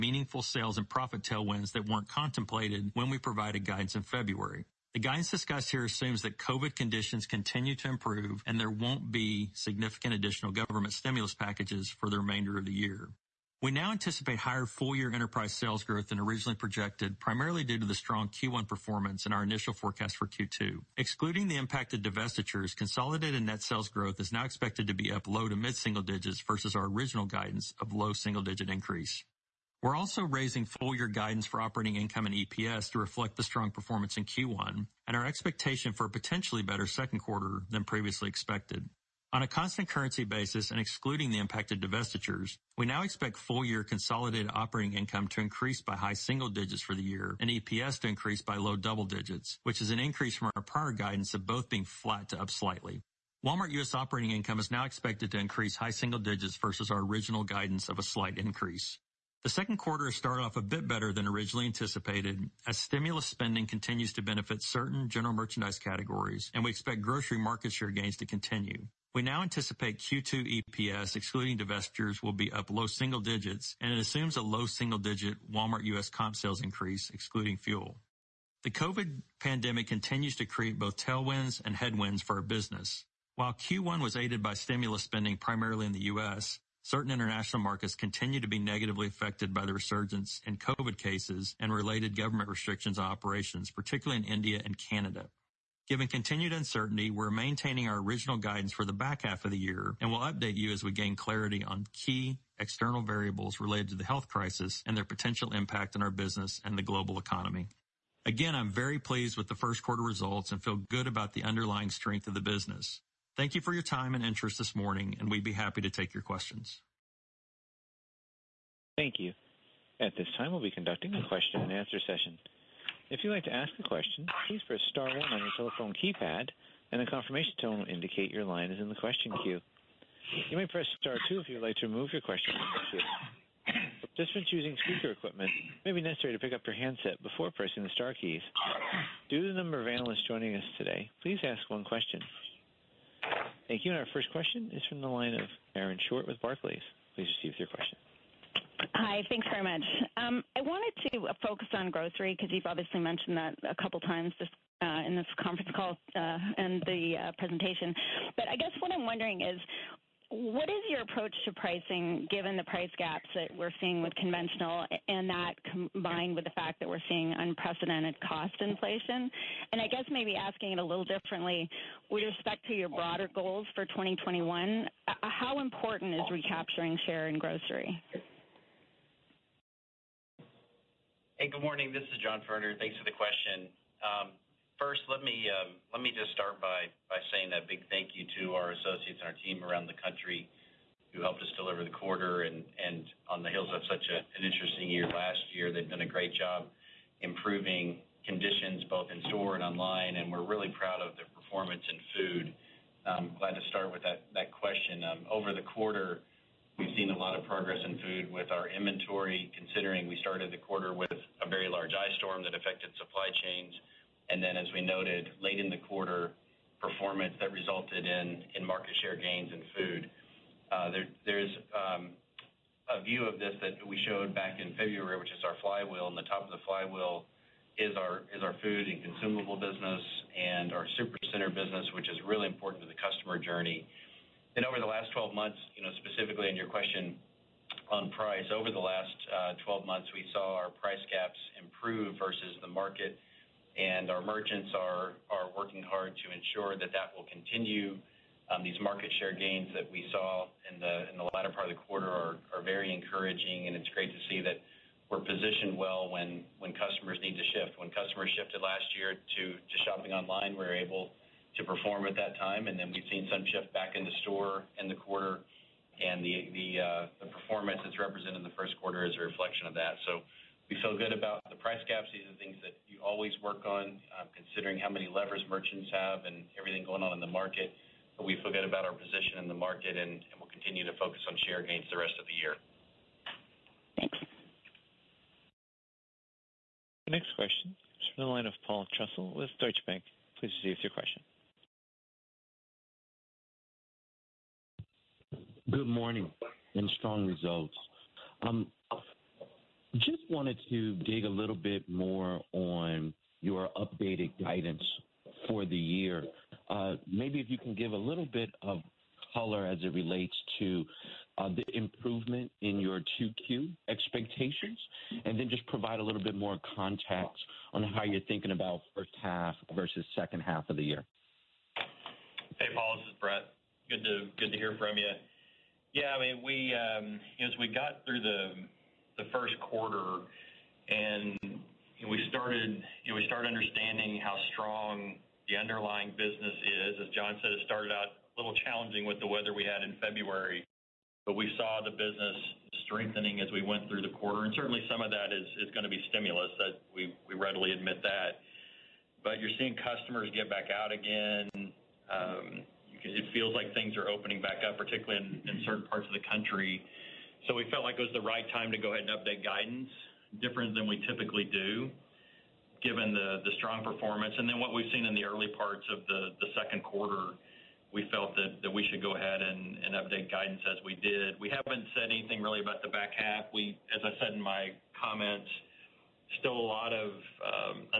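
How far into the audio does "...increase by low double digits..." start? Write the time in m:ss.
0:48.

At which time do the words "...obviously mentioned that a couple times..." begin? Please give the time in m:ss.
2:32.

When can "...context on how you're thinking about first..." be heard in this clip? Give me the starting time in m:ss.
5:16.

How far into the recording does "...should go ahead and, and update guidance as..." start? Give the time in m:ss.
6:08.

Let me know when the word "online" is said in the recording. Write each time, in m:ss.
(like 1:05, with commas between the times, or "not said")
3:19, 4:20.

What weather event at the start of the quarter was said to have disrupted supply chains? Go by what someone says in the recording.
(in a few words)
ice storm.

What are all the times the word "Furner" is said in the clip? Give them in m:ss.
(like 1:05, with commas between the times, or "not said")
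3:02.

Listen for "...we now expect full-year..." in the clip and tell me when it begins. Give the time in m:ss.
0:42.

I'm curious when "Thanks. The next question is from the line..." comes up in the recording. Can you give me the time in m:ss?
4:44.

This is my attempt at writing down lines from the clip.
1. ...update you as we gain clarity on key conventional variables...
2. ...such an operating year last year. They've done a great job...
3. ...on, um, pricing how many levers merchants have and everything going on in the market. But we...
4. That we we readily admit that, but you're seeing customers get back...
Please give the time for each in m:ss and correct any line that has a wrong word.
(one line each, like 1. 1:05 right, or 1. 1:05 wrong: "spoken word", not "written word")
1. 1:40 wrong: "external", not "conventional"
2. 3:13 wrong: "interesting", not "operating"
3. 4:33 wrong: "considering", not "pricing"
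4. 5:46 right.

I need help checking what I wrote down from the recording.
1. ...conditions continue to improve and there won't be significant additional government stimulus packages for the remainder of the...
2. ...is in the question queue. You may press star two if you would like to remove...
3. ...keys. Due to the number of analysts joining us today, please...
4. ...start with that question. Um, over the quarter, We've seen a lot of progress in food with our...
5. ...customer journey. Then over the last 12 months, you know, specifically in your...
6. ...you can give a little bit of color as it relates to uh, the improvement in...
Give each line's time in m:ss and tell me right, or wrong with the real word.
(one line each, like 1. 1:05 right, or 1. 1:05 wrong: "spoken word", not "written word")
1. 0:06 right
2. 2:08 right
3. 2:18 right
4. 3:23 right
5. 3:52 right
6. 5:07 right.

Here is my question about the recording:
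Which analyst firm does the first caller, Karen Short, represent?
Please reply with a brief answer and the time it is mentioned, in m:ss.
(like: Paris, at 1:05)
Barclays, at 2:26.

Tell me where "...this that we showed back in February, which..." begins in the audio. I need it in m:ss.
3:43.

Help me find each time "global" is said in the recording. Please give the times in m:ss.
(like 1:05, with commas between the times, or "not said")
1:46.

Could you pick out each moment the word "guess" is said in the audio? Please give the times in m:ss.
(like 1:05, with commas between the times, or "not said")
2:38, 2:49.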